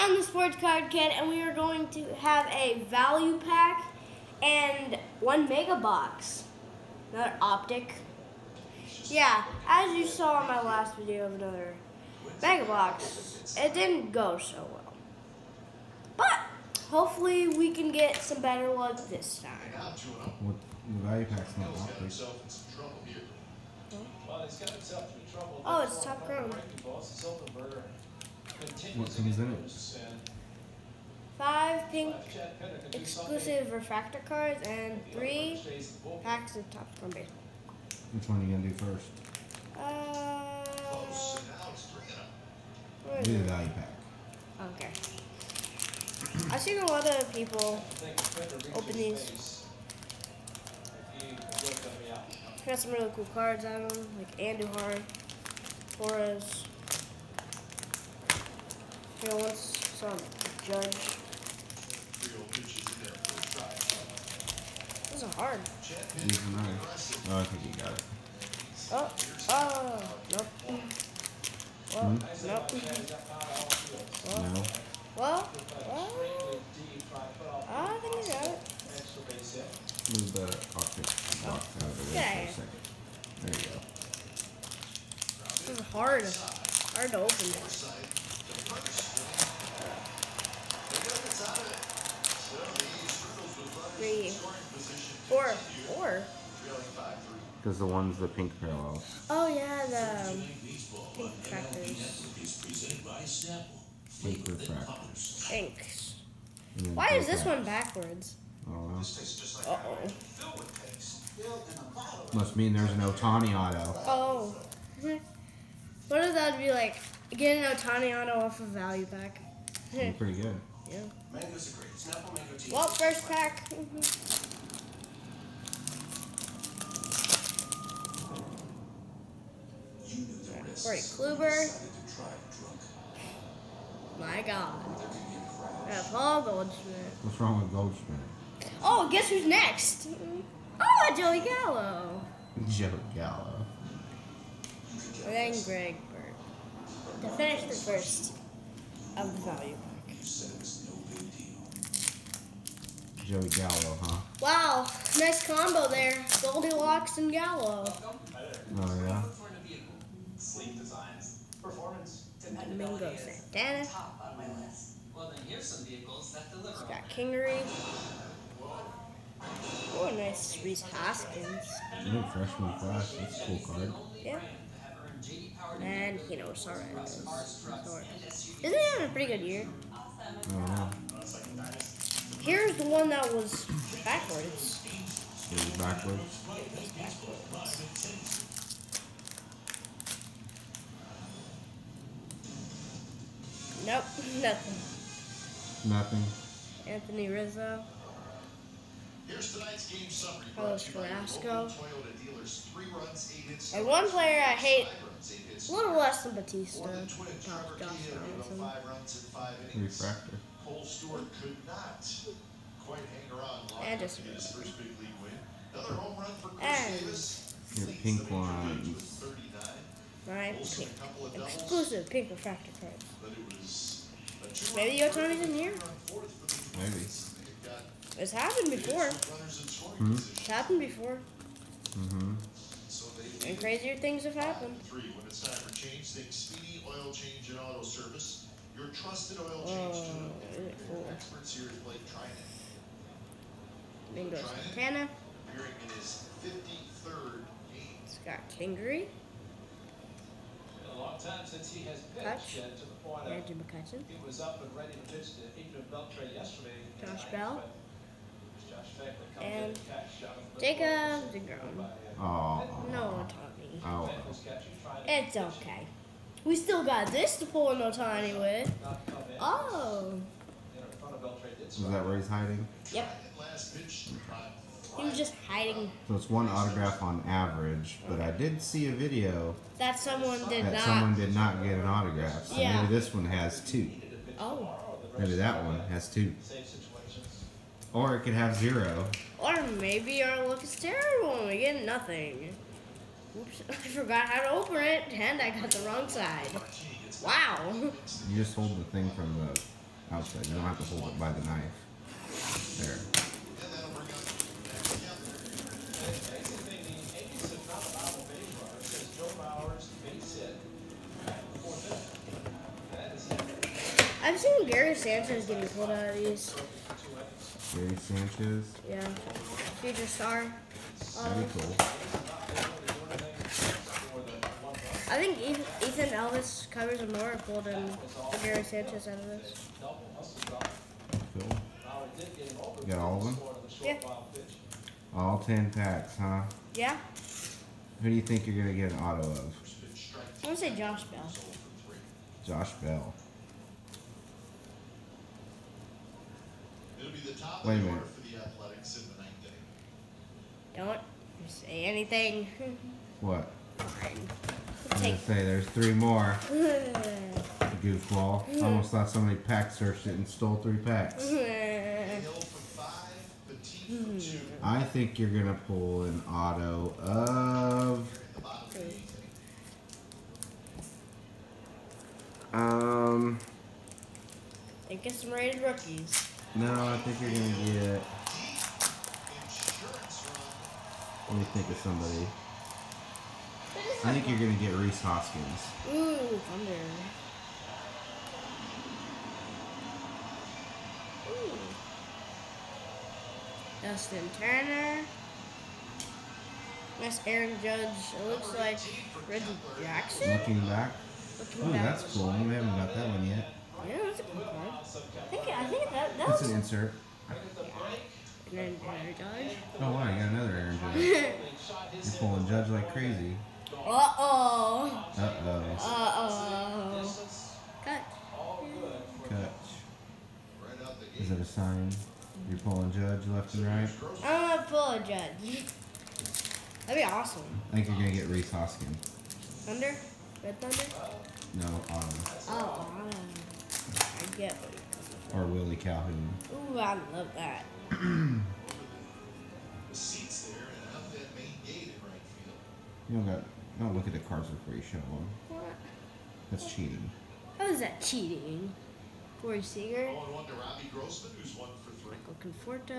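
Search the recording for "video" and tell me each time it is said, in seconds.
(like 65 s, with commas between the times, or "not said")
10 s, 278 s.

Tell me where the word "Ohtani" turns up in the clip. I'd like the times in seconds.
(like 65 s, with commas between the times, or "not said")
113 s, 117 s.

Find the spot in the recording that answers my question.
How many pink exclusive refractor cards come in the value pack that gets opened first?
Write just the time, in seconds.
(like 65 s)
31 s.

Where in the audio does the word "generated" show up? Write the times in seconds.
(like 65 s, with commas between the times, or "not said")
not said.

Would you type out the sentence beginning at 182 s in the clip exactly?
Here's the one that was backwards.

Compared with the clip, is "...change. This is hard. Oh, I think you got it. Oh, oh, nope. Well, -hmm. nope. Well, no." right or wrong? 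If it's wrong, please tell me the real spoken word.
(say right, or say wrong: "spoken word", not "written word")
wrong: "judge", not "change".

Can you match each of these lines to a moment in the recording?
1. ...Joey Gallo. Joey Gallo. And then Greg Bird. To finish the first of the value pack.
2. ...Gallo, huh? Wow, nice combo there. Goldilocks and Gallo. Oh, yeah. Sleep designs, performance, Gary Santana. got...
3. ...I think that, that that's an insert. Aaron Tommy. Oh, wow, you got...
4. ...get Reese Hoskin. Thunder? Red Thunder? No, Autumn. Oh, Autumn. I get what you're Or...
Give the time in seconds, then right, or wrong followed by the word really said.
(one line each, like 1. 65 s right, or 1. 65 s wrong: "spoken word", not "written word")
1. 141 s right
2. 153 s wrong: "Domingo", not "Gary"
3. 405 s wrong: "Judge", not "Tommy"
4. 428 s right.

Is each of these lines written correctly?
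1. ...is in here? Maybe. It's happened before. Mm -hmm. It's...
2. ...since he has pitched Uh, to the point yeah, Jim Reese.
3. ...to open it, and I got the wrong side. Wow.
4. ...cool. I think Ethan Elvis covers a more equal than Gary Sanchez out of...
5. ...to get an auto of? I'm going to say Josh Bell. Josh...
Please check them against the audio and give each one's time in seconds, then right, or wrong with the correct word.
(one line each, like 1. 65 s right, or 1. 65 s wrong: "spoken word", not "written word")
1. 225 s right
2. 251 s wrong: "McCutcheon", not "Reese"
3. 294 s right
4. 321 s right
5. 338 s right.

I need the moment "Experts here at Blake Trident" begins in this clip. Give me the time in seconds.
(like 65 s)
241 s.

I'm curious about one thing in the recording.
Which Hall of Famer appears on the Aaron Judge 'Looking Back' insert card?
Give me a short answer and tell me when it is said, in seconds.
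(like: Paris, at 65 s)
Reggie Jackson, at 399 s.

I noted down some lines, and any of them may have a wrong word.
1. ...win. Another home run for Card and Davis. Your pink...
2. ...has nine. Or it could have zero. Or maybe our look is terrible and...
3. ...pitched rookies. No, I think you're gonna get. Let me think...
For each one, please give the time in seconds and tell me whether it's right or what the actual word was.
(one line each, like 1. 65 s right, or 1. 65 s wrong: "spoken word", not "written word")
1. 215 s wrong: "Chris", not "Card"
2. 285 s wrong: "two", not "nine"
3. 375 s wrong: "rated", not "pitched".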